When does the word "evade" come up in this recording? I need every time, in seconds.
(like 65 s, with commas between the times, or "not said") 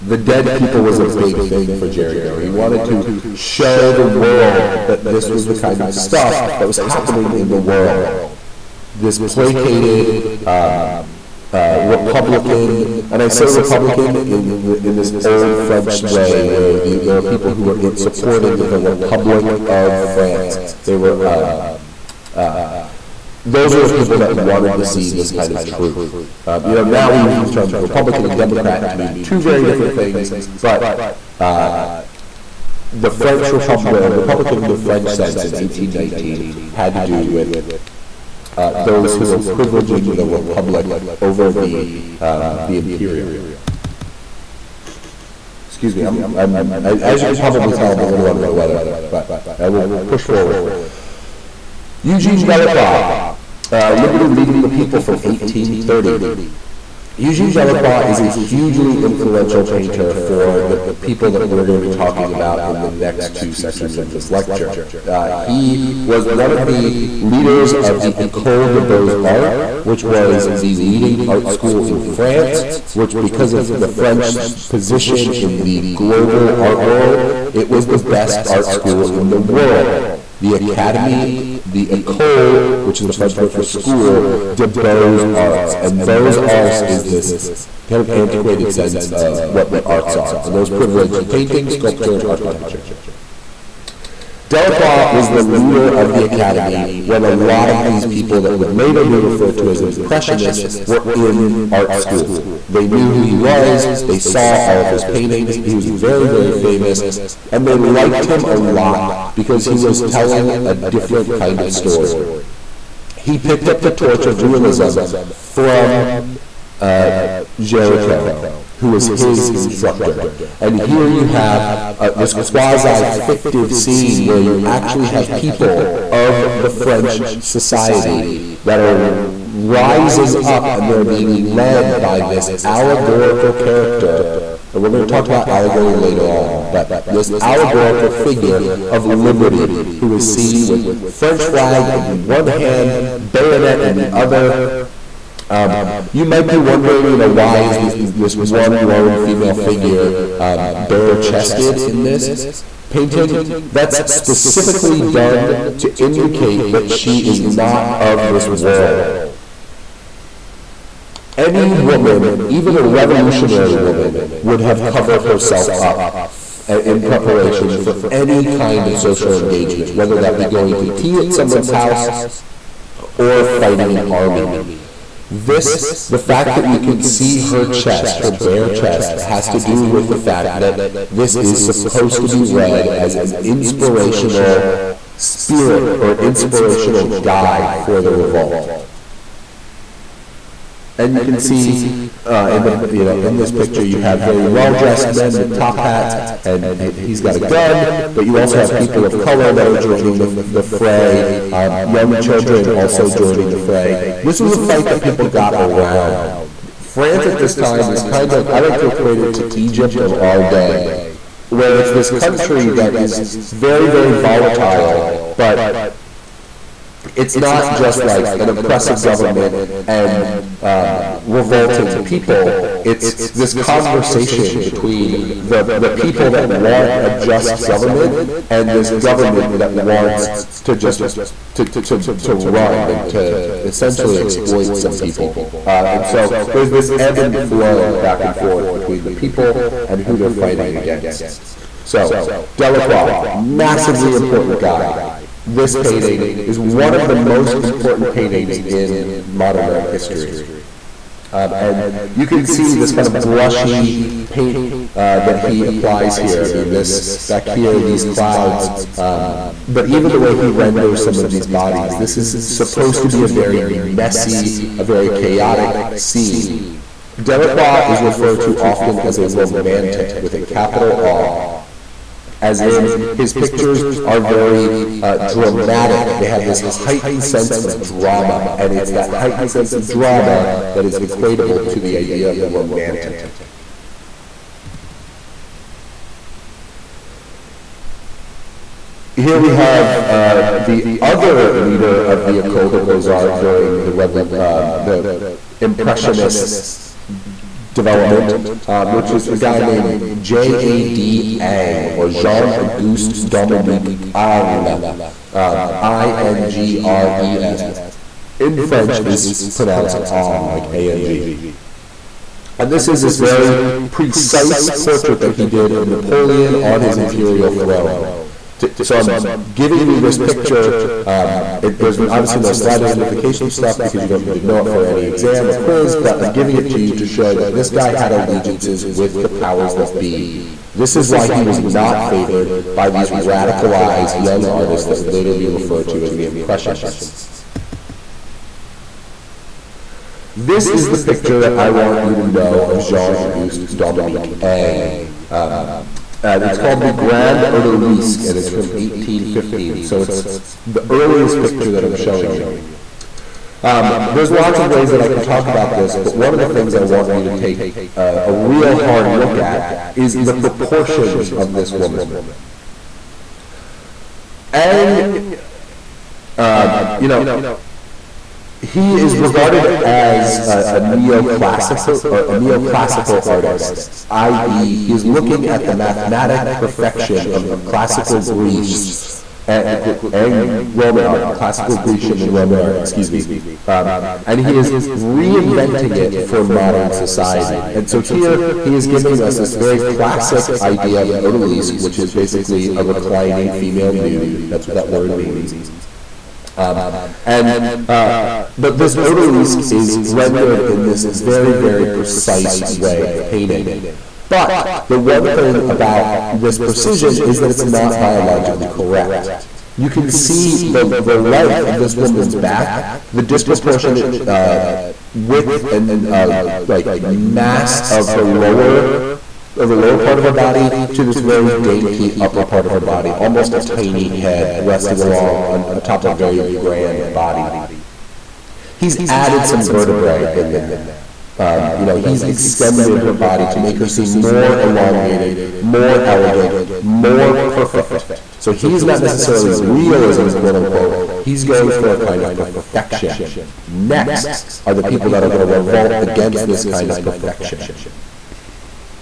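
not said.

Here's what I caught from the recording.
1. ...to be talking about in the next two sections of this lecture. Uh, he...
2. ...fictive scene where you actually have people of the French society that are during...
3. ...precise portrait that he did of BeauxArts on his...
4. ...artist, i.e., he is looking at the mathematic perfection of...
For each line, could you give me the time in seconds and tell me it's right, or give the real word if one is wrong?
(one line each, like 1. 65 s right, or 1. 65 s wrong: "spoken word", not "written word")
1. 61 s right
2. 123 s wrong: "rising", not "during"
3. 313 s wrong: "Napoleon", not "BeauxArts"
4. 373 s right.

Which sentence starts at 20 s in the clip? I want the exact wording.
They were um, uh, those are the people that wanted to see this kind of truth.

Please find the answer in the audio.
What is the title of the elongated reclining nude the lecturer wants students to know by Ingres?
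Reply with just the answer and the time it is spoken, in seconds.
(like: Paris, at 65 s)
Grand Odalisque, at 346 s.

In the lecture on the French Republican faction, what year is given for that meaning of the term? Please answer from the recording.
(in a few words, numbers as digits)
1819.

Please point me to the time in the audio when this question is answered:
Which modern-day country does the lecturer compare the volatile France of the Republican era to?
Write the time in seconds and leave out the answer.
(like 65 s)
209 s.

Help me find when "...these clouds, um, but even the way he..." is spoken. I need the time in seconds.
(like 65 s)
257 s.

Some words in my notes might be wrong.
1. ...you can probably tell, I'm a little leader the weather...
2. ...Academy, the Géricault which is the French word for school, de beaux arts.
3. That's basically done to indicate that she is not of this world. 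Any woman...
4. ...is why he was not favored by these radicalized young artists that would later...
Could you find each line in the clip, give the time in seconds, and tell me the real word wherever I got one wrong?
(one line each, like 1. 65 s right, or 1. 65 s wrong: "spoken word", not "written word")
1. 47 s wrong: "under", not "leader"
2. 80 s wrong: "Ecole", not "Géricault"
3. 153 s wrong: "specifically", not "basically"
4. 330 s right.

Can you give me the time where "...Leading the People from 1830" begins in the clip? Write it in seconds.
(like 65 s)
54 s.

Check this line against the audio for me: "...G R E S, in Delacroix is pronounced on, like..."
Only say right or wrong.
wrong.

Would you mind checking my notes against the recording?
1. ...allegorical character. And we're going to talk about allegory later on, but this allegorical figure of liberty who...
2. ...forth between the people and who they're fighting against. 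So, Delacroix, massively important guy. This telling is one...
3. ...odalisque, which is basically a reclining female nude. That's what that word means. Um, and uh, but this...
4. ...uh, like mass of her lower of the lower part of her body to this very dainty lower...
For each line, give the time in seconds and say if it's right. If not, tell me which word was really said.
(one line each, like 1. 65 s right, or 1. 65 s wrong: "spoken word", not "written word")
1. 132 s right
2. 238 s wrong: "painting", not "telling"
3. 391 s right
4. 416 s wrong: "upper", not "lower".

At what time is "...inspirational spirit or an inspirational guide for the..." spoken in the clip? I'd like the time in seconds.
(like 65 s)
183 s.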